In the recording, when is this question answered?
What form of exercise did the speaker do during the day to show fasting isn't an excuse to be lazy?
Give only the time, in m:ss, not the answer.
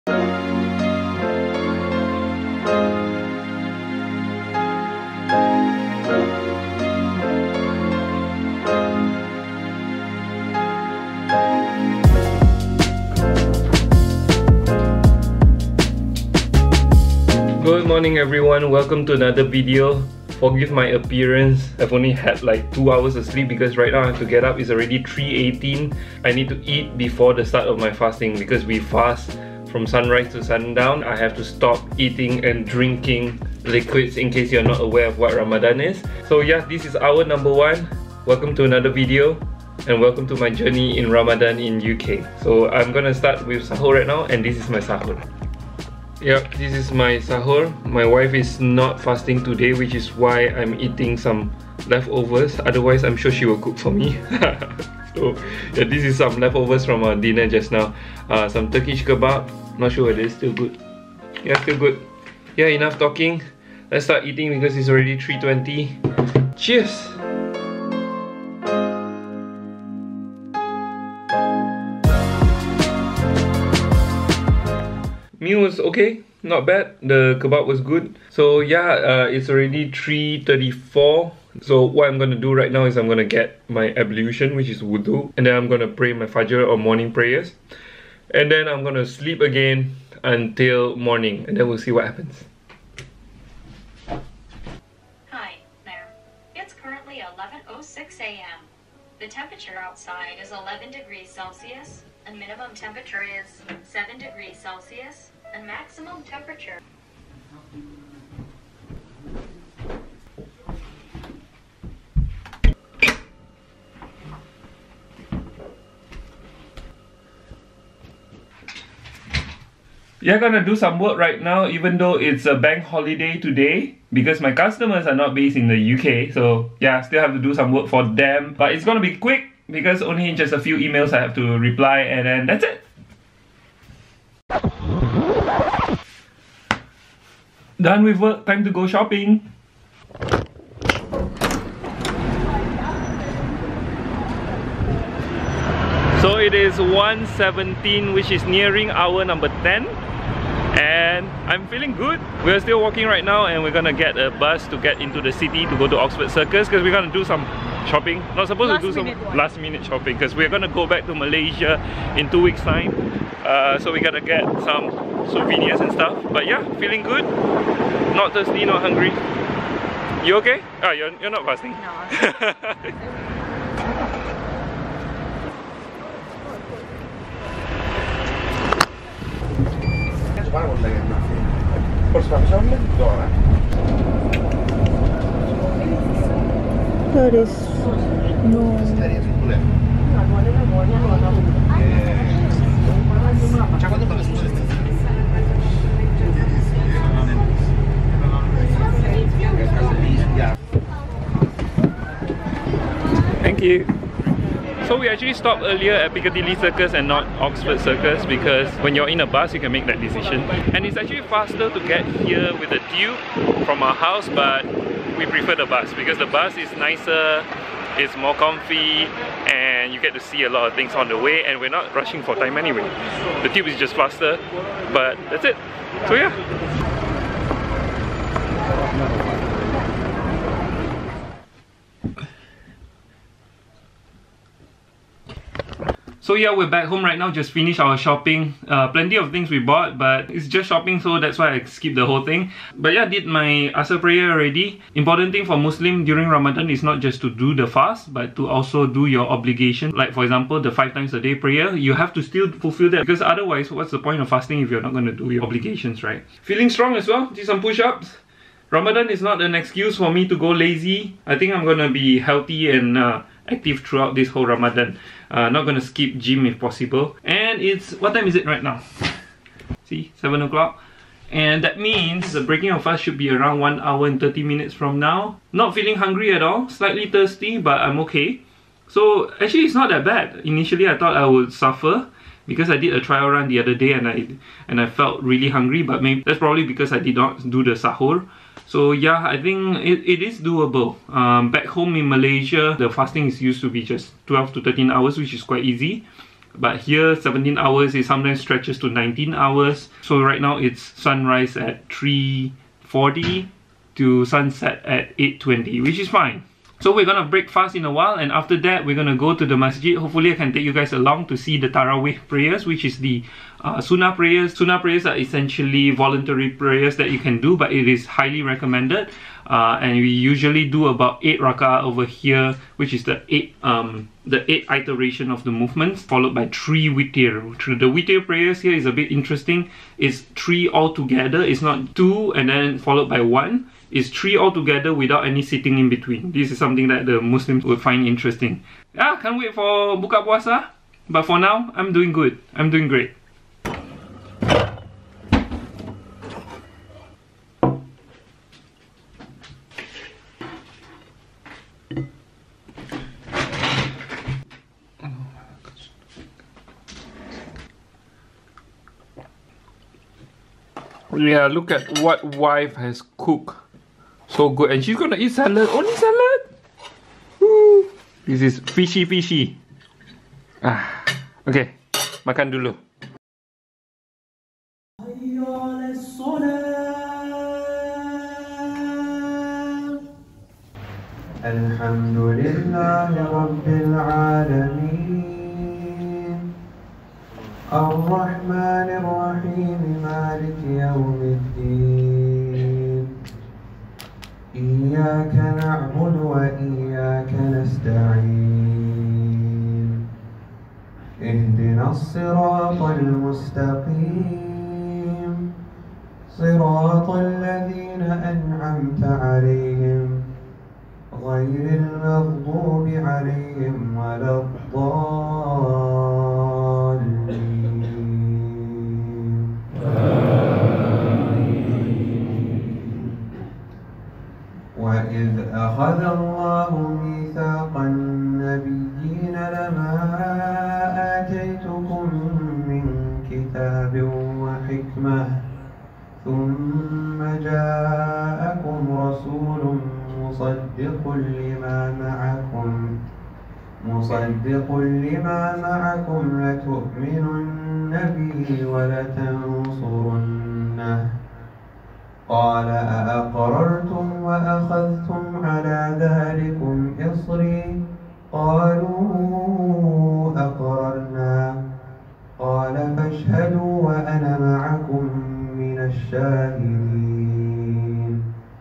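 4:17.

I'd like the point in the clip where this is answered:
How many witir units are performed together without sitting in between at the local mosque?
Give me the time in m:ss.
5:26.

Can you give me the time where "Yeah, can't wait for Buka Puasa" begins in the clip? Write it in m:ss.
5:38.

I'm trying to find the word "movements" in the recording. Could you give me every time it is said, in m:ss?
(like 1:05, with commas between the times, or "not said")
5:25.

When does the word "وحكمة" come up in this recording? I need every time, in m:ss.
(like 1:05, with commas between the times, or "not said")
7:14.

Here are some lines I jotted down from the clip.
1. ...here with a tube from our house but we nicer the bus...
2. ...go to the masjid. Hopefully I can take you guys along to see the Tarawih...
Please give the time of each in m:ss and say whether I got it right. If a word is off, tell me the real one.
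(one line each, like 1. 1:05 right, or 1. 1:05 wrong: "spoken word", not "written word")
1. 3:32 wrong: "prefer", not "nicer"
2. 5:09 right.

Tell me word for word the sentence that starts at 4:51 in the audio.
Um, back home in Malaysia, the fasting is used to be just 12 to 13 hours, which is quite easy.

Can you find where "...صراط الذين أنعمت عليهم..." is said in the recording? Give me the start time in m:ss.
6:46.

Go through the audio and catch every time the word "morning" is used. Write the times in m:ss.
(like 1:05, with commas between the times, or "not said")
0:17, 1:26, 1:30.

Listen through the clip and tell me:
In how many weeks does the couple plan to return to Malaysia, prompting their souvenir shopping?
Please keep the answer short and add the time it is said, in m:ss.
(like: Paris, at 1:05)
2, at 2:42.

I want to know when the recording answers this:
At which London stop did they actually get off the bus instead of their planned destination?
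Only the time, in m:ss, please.
3:26.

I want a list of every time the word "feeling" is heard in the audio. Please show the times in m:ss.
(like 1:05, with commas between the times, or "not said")
2:31, 2:46, 4:16, 4:35.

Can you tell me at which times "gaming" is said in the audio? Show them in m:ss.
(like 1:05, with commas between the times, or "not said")
not said.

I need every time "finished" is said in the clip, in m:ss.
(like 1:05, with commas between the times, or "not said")
3:57.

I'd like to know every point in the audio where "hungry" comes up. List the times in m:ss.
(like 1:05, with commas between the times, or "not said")
2:48, 4:35, 4:45.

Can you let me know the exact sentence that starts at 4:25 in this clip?
Uh, not gonna skip gym if possible.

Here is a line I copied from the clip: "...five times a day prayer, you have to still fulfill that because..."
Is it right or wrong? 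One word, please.
right.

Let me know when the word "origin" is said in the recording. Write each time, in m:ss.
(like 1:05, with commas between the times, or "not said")
not said.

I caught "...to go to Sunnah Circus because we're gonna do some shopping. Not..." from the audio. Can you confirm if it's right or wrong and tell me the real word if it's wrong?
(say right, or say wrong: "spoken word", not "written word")
wrong: "Oxford", not "Sunnah".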